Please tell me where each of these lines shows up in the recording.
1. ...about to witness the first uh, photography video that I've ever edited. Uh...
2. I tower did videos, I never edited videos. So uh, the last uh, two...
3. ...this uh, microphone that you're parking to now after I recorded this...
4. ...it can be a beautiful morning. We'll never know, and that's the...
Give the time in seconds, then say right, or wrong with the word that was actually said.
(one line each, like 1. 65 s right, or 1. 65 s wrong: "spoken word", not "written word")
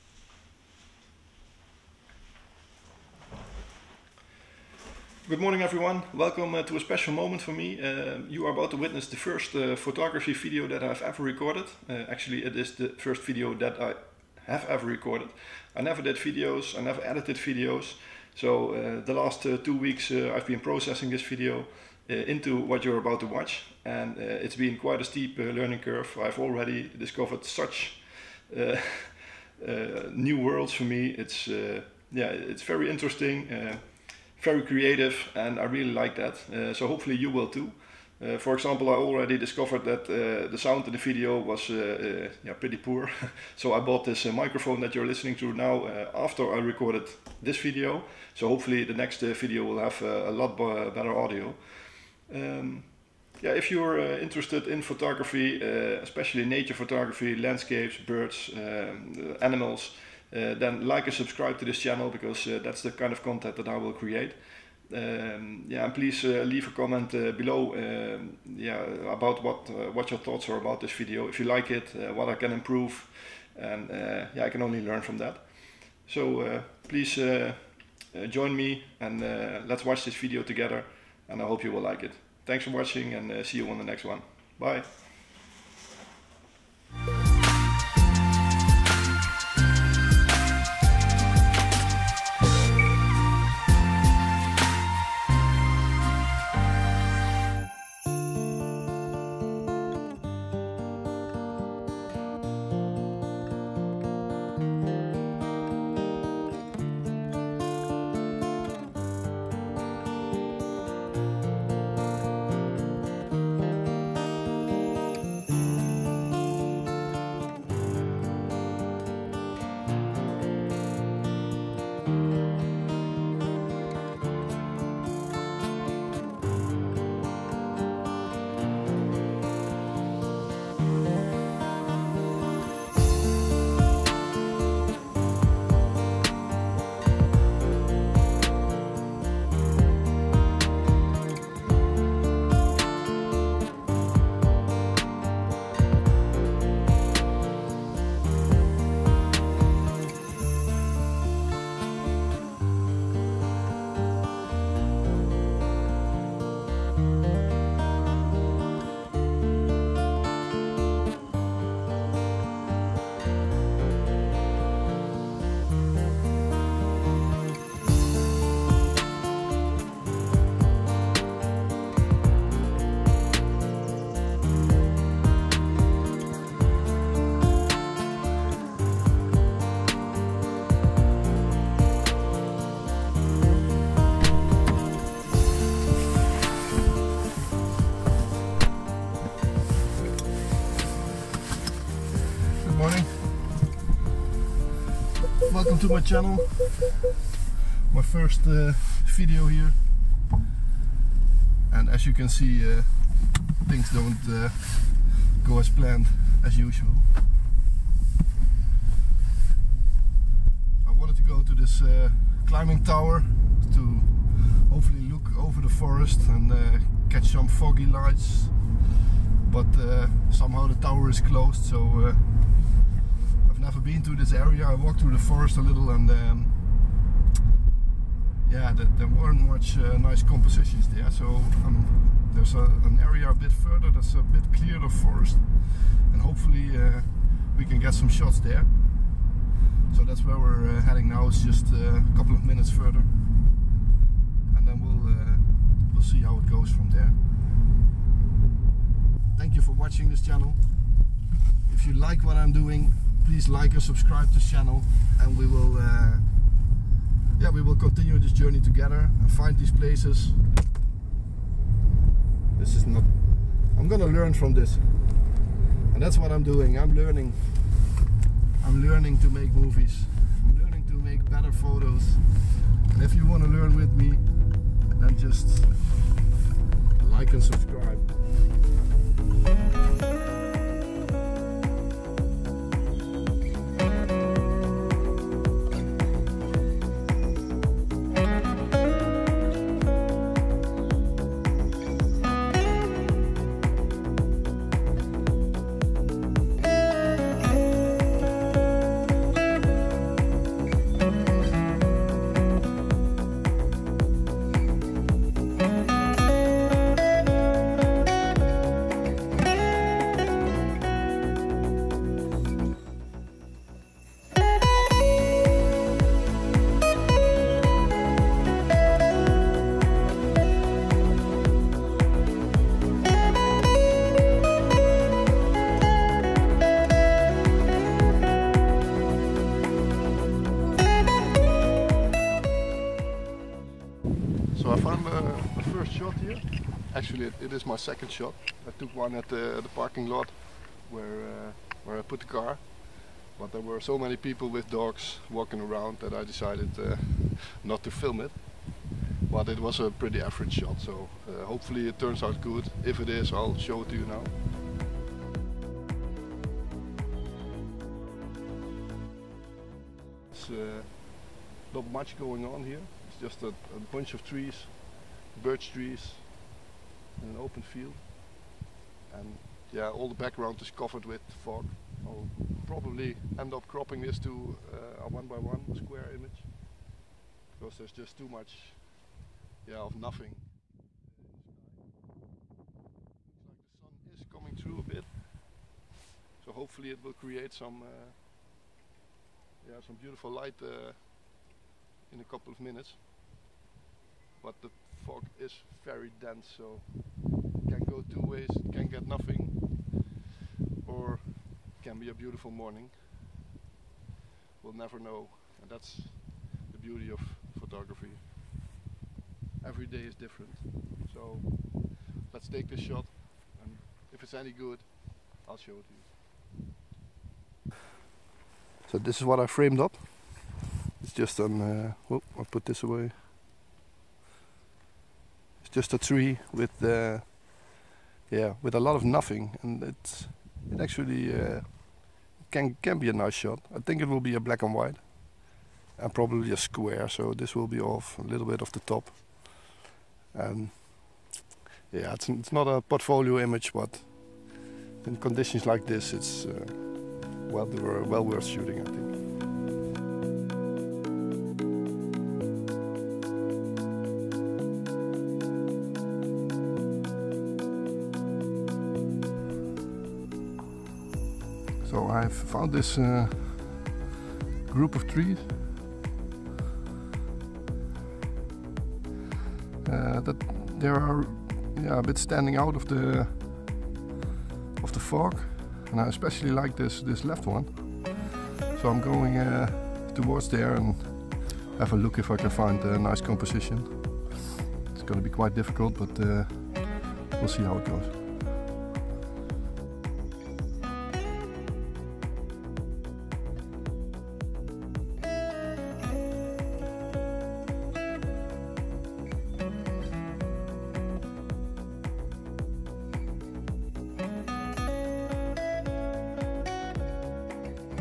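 1. 8 s wrong: "recorded", not "edited"
2. 15 s wrong: "never", not "tower"
3. 44 s wrong: "listening", not "parking"
4. 401 s right.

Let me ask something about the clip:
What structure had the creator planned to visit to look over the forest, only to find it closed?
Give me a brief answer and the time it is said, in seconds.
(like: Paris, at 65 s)
Climbing tower, at 212 s.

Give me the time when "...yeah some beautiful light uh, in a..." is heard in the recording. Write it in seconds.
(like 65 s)
389 s.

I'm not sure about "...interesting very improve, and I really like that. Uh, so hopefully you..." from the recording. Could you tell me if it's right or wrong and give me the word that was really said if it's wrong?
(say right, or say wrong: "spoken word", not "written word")
wrong: "creative", not "improve".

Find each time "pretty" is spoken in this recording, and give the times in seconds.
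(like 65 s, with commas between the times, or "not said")
42 s, 349 s.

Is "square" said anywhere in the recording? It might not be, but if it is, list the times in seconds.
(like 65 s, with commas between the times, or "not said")
375 s, 436 s.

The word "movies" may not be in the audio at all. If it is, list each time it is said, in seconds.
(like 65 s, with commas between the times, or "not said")
269 s.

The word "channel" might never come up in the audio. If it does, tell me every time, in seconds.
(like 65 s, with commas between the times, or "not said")
61 s, 196 s, 250 s, 254 s.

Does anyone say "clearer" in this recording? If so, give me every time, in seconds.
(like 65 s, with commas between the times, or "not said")
234 s.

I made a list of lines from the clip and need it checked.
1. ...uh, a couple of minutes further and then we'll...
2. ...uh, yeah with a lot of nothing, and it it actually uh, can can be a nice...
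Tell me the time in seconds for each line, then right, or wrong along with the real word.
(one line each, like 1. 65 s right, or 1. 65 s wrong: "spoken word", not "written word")
1. 241 s right
2. 426 s right.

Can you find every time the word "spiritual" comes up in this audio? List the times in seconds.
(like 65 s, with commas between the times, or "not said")
not said.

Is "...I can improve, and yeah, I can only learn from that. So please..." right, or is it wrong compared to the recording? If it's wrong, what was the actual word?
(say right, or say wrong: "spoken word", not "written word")
right.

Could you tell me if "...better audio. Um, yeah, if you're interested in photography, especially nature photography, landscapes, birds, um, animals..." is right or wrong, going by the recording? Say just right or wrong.
right.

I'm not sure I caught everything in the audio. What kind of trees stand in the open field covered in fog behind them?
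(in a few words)
Birch trees.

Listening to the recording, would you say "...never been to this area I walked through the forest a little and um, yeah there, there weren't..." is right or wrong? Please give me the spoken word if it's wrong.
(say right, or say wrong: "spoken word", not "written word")
right.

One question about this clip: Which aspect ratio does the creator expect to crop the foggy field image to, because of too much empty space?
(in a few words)
1 by 1.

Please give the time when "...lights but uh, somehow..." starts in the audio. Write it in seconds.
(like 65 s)
217 s.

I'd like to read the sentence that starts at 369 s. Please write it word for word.
And yeah, all the background is covered with fog.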